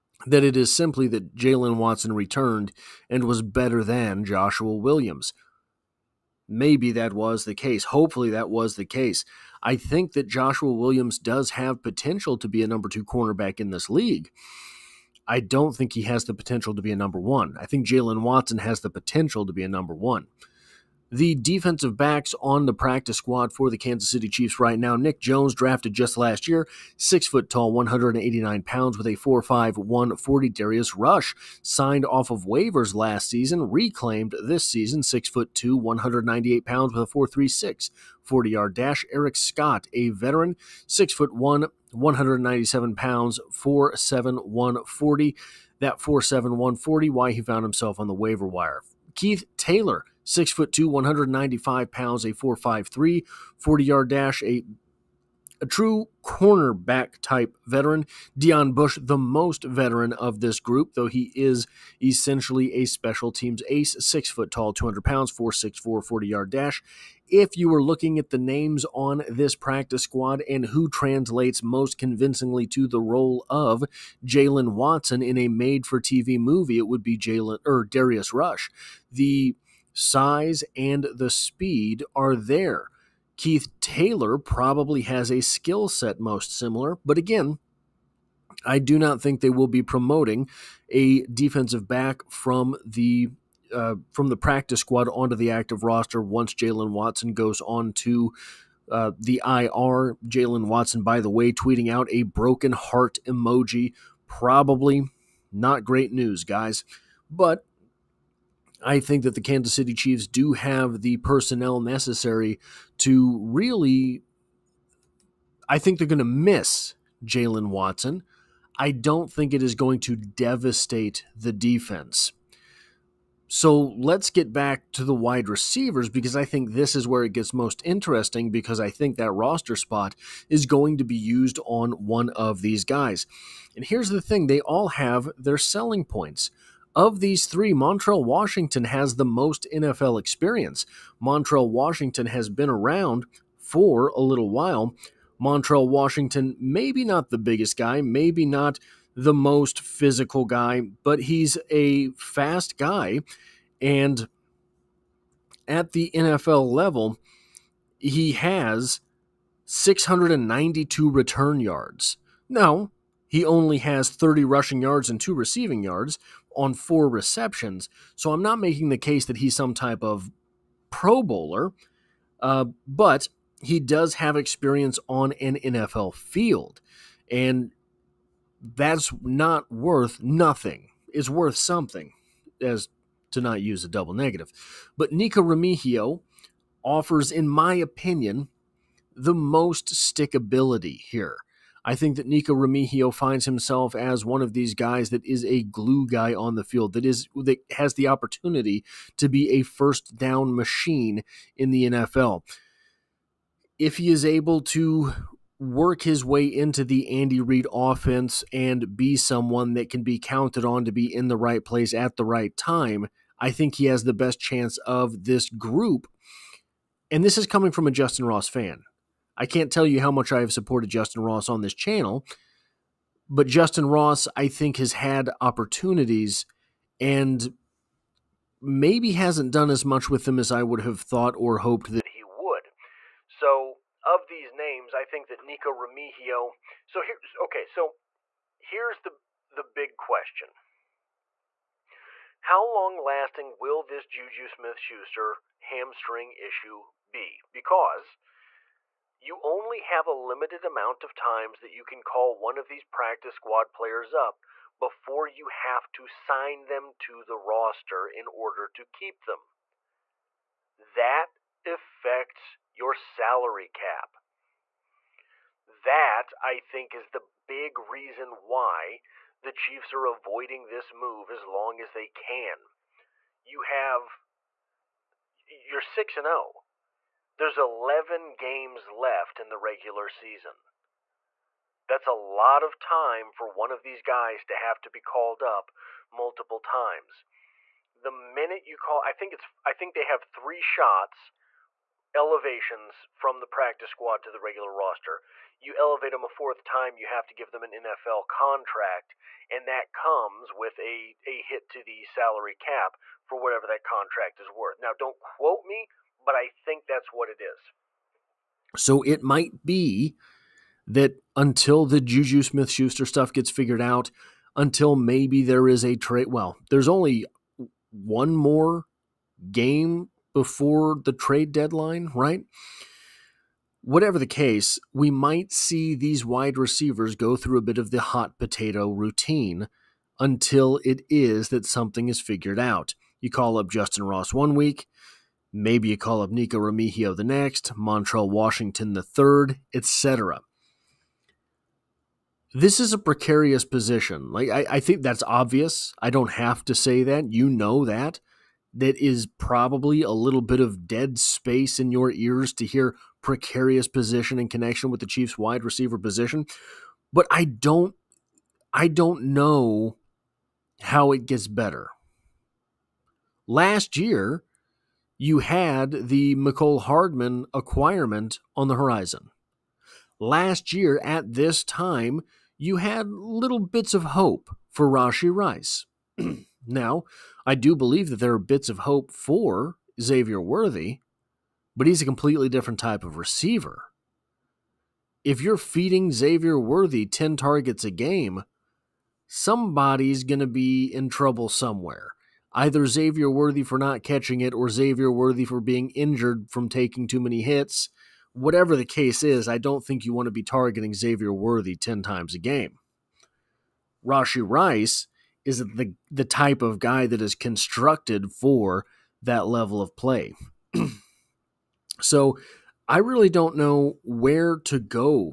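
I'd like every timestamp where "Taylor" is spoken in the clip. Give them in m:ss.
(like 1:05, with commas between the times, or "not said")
0:49, 1:23.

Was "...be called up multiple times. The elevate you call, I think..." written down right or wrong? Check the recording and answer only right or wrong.
wrong.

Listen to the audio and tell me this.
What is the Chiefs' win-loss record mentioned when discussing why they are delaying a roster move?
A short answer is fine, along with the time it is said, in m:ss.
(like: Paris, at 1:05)
6-0, at 4:35.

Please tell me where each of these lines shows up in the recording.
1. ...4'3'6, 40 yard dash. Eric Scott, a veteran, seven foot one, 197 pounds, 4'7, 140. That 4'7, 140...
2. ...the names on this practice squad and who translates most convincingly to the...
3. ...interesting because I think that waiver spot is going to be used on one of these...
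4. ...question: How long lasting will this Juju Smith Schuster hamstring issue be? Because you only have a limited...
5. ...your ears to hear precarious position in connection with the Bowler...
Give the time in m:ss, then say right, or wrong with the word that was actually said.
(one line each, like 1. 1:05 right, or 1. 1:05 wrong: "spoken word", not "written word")
1. 0:37 wrong: "six", not "seven"
2. 1:08 right
3. 2:07 wrong: "roster", not "waiver"
4. 3:59 right
5. 5:51 wrong: "Chiefs", not "Bowler".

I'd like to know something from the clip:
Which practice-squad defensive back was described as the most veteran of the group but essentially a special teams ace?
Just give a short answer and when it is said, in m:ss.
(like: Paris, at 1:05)
Deon Bush, at 0:58.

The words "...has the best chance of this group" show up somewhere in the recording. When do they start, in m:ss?
3:33.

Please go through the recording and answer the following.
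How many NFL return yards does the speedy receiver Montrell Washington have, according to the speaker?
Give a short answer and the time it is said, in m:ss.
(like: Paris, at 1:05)
692, at 2:39.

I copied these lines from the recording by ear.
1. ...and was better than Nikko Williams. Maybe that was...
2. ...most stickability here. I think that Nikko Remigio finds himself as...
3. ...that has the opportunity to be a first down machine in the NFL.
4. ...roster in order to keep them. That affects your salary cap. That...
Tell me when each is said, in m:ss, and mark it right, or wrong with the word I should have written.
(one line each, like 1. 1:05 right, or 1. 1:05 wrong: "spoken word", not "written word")
1. 0:03 wrong: "Joshua", not "Nikko"
2. 3:09 right
3. 3:17 right
4. 4:17 right.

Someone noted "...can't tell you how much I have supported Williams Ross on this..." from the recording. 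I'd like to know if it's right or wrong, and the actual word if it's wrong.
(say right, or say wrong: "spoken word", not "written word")
wrong: "Justin", not "Williams".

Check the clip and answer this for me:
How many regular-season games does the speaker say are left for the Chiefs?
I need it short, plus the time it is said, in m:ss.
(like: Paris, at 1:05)
11, at 4:37.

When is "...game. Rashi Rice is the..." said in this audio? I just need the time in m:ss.
6:42.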